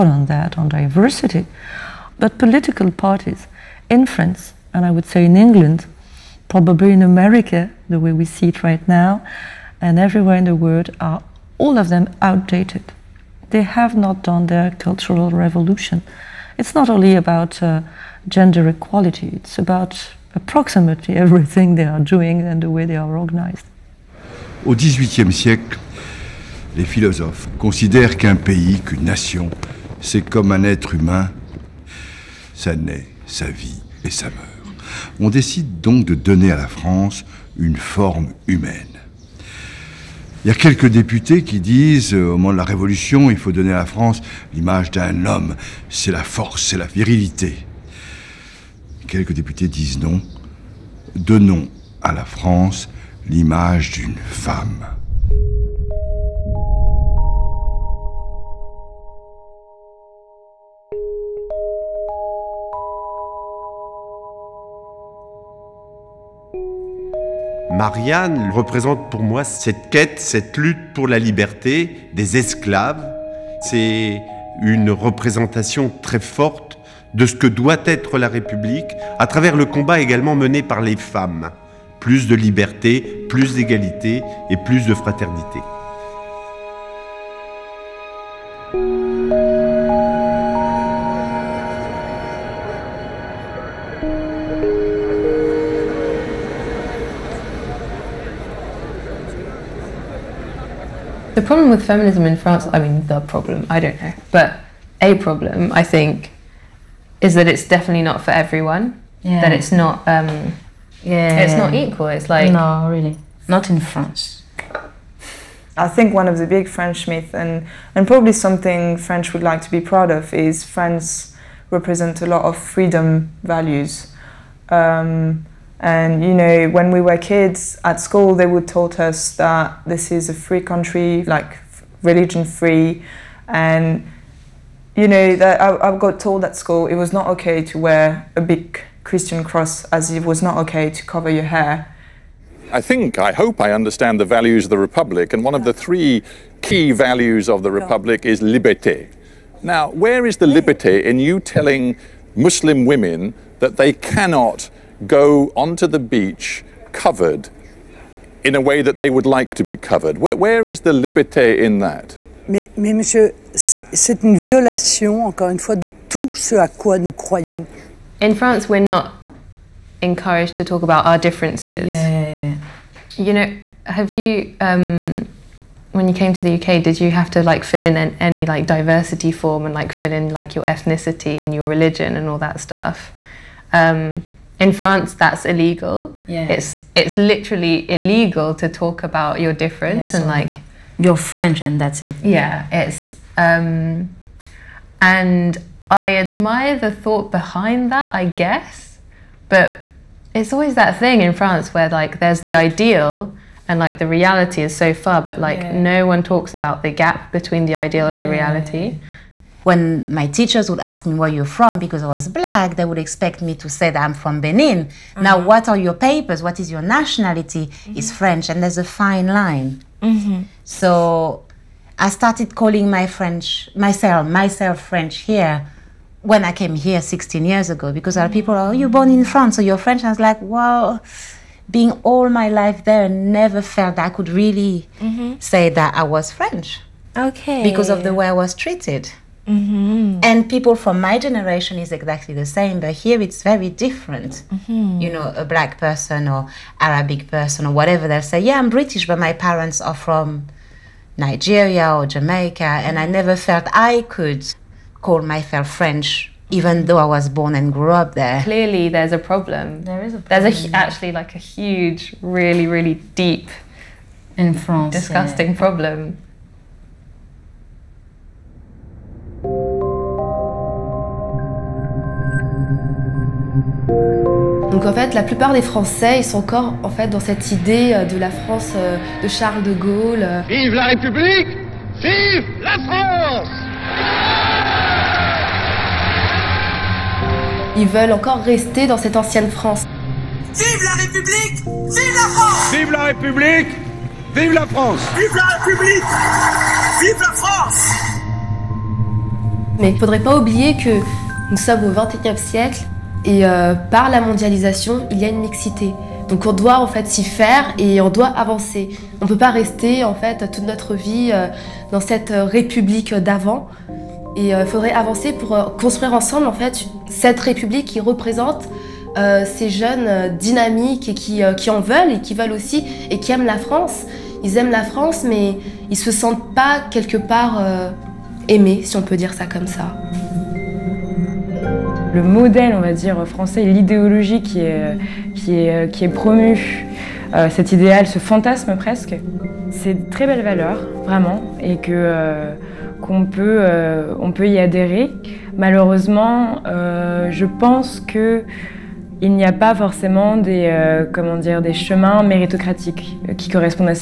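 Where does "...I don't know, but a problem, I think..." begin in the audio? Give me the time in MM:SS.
01:43.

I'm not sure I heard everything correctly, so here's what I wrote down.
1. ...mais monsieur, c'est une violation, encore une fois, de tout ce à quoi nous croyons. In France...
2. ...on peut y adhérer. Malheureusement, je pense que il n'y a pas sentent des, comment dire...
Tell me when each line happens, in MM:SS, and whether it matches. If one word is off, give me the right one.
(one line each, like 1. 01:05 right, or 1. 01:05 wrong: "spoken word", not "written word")
1. 02:42 right
2. 05:44 wrong: "forcément", not "sentent".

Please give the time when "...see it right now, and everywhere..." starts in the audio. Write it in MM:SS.
00:08.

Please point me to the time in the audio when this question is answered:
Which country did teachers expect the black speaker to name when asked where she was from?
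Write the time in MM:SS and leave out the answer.
03:34.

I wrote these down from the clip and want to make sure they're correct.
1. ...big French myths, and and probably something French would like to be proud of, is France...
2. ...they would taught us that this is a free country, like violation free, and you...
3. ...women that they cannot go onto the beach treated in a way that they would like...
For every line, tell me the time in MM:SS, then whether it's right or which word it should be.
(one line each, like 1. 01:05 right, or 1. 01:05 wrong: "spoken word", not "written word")
1. 01:56 right
2. 02:08 wrong: "religion", not "violation"
3. 02:32 wrong: "covered", not "treated".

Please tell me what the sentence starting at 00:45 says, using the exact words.
C'est la force, c'est la virilité.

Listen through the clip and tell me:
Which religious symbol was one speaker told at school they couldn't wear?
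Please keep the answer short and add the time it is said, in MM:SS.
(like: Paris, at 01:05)
A big Christian cross, at 02:18.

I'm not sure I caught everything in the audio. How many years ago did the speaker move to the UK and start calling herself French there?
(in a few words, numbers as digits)
16.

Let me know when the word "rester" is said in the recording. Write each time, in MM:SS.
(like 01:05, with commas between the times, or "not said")
04:48, 05:09.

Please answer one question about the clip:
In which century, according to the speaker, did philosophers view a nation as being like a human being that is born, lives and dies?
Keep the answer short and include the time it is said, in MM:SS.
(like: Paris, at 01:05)
18th century, at 00:24.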